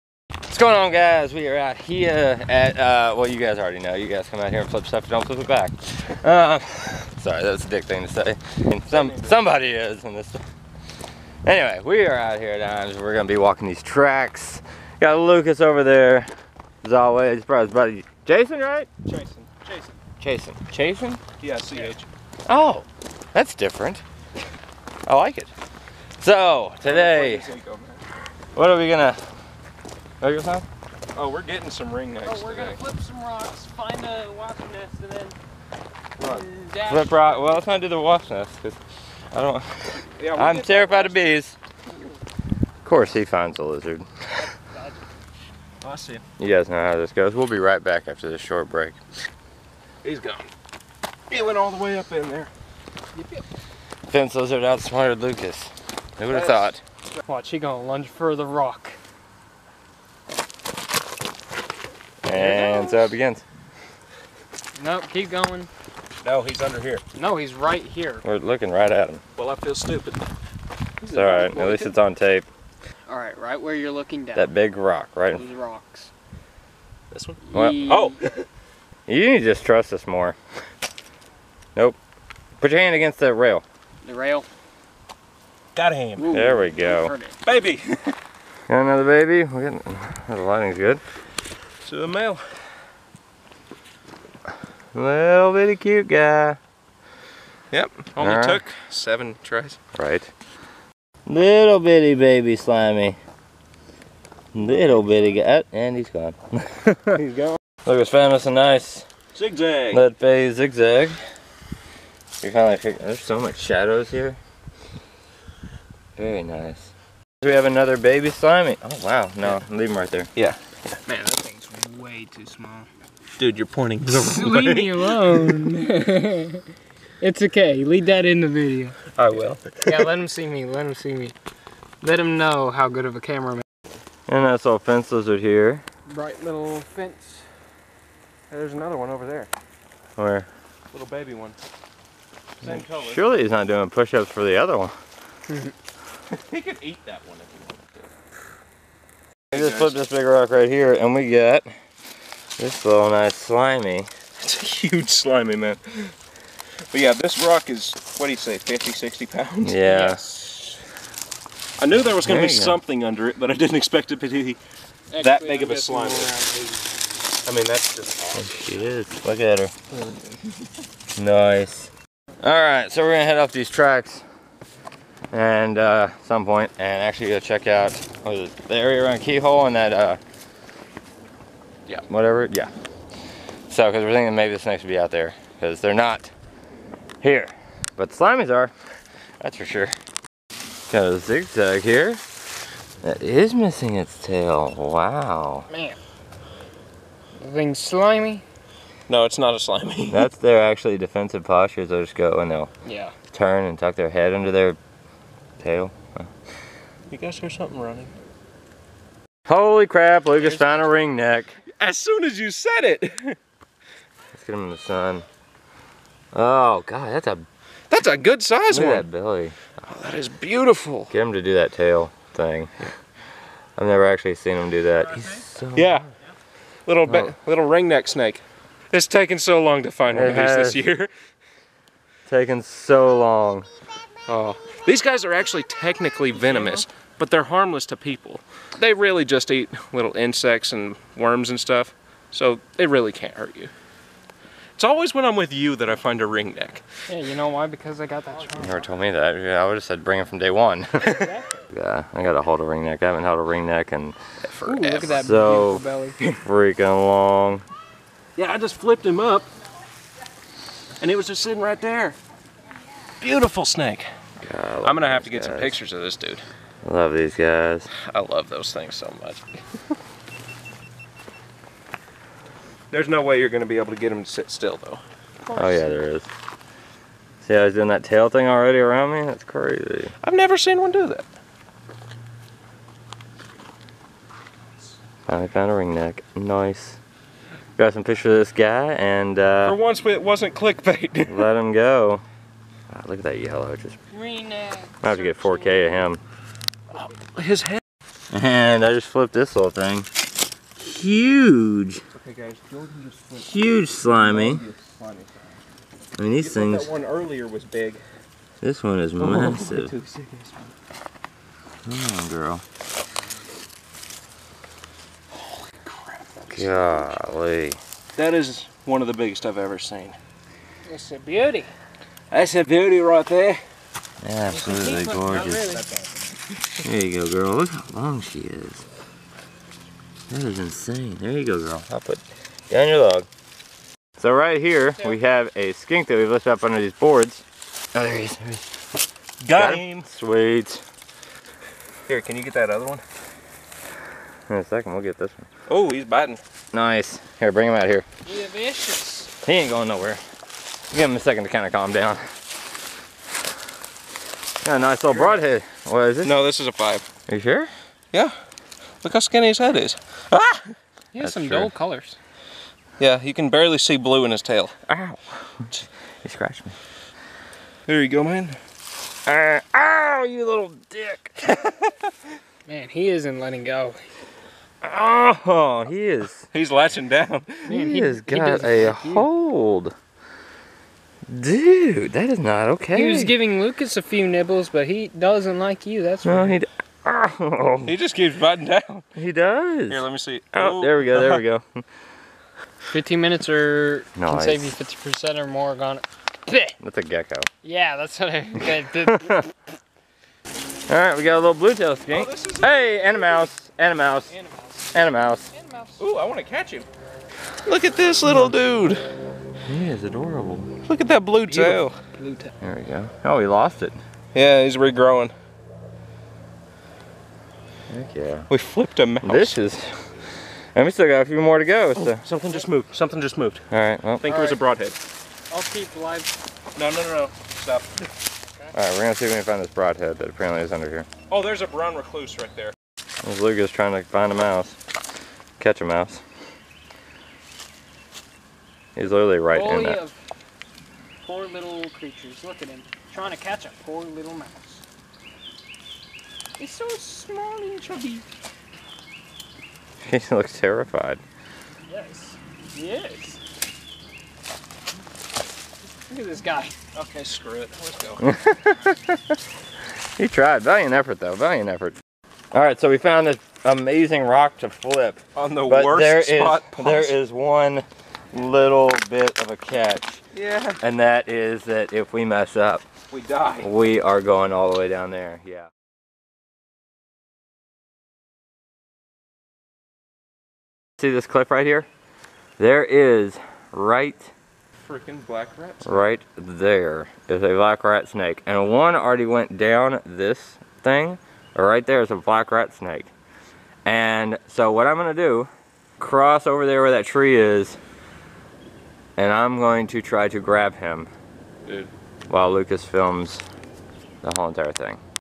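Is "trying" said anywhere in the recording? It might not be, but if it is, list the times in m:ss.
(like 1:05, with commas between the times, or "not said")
7:13, 7:23.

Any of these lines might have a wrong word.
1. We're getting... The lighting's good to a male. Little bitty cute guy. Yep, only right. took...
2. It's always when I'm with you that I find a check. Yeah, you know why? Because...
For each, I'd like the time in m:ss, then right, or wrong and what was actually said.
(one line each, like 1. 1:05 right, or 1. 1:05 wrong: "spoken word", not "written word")
1. 1:29 right
2. 4:04 wrong: "ringneck", not "check".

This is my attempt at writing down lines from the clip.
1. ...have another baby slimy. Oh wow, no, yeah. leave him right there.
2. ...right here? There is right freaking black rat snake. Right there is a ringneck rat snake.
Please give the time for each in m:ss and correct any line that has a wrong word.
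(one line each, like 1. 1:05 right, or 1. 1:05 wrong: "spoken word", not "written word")
1. 1:57 right
2. 8:01 wrong: "black", not "ringneck".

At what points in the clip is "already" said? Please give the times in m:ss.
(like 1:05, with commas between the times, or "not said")
0:03, 4:38, 8:08.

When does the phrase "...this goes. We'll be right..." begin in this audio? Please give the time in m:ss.
0:46.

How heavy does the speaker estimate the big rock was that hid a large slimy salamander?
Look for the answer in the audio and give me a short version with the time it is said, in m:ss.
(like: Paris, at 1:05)
50 to 60 pounds, at 2:38.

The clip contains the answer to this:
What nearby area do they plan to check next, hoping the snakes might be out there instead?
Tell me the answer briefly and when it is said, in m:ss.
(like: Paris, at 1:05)
Keyhole, at 2:59.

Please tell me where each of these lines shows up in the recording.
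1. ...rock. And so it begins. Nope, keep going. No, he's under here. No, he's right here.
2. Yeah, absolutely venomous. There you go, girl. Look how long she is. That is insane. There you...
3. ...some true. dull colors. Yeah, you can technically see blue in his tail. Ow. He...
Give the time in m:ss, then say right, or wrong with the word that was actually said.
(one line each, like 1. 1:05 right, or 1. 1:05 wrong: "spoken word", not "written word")
1. 0:58 right
2. 5:24 wrong: "gorgeous", not "venomous"
3. 6:01 wrong: "barely", not "technically".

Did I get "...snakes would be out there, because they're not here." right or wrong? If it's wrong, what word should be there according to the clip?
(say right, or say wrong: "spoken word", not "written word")
right.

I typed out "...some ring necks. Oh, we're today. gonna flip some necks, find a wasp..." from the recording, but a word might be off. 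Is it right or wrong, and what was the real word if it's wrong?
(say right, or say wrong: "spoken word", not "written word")
wrong: "rocks", not "necks".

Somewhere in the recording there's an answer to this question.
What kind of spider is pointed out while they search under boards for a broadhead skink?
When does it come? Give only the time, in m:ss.
7:11.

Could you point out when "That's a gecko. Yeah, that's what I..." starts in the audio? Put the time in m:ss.
6:36.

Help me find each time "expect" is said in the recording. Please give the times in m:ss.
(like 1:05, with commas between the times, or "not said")
2:43.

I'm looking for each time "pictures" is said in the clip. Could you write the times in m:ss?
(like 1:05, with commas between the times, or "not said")
4:25, 4:48.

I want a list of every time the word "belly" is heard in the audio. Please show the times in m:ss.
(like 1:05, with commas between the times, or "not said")
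3:39, 4:15.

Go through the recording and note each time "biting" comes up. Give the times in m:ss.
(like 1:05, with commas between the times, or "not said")
5:46, 6:28.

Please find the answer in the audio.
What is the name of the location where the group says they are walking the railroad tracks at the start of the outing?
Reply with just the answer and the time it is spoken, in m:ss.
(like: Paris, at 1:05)
Imes, at 0:12.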